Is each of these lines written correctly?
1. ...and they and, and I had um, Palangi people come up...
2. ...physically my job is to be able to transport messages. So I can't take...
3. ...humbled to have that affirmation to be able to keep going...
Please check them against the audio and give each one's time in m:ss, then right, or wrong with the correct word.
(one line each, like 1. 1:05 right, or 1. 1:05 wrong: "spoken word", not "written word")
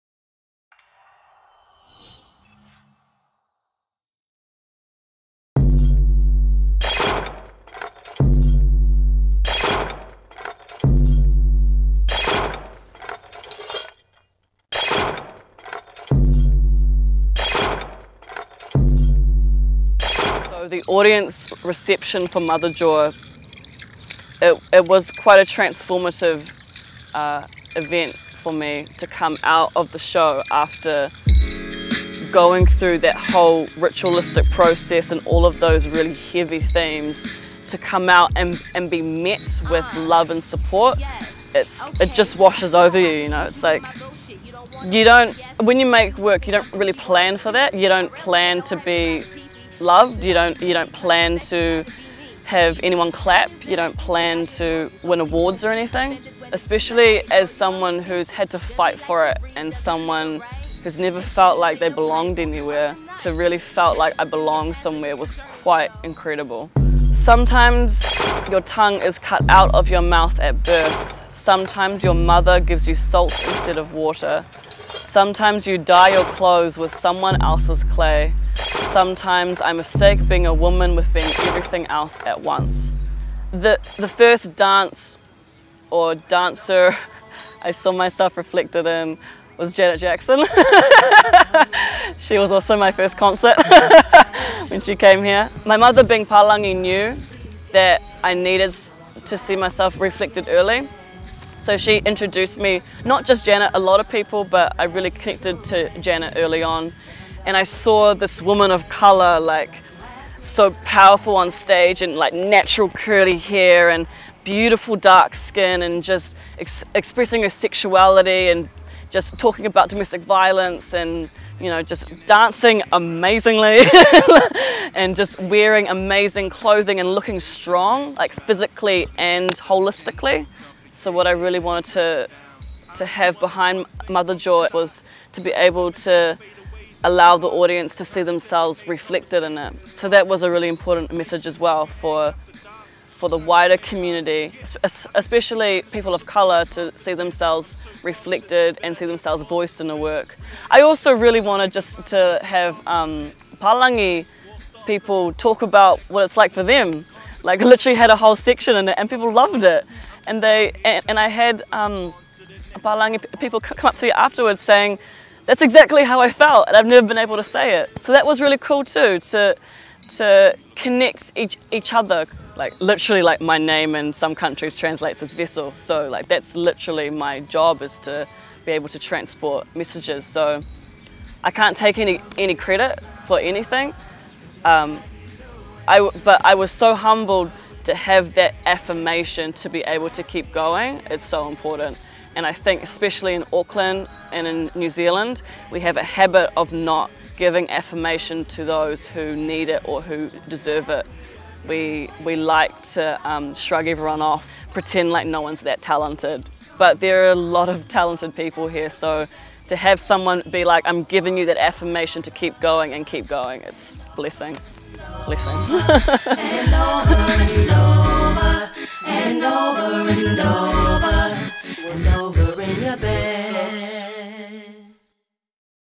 1. 2:40 right
2. 2:56 wrong: "literally", not "physically"
3. 3:06 right.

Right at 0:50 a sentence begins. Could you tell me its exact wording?
You don't, you don't plan to have anyone clap.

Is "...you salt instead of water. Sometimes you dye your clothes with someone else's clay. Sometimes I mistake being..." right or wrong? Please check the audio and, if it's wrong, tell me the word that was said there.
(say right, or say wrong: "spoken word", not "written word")
right.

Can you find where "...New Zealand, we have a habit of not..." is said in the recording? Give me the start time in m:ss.
3:14.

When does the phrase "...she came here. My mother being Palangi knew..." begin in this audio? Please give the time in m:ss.
1:34.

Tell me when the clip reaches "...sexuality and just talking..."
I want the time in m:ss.
1:57.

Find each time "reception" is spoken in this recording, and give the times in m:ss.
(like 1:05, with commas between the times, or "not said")
0:21.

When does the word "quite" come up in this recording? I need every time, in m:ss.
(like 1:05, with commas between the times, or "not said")
0:25, 1:05.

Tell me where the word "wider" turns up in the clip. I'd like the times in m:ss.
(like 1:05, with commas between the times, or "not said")
2:23.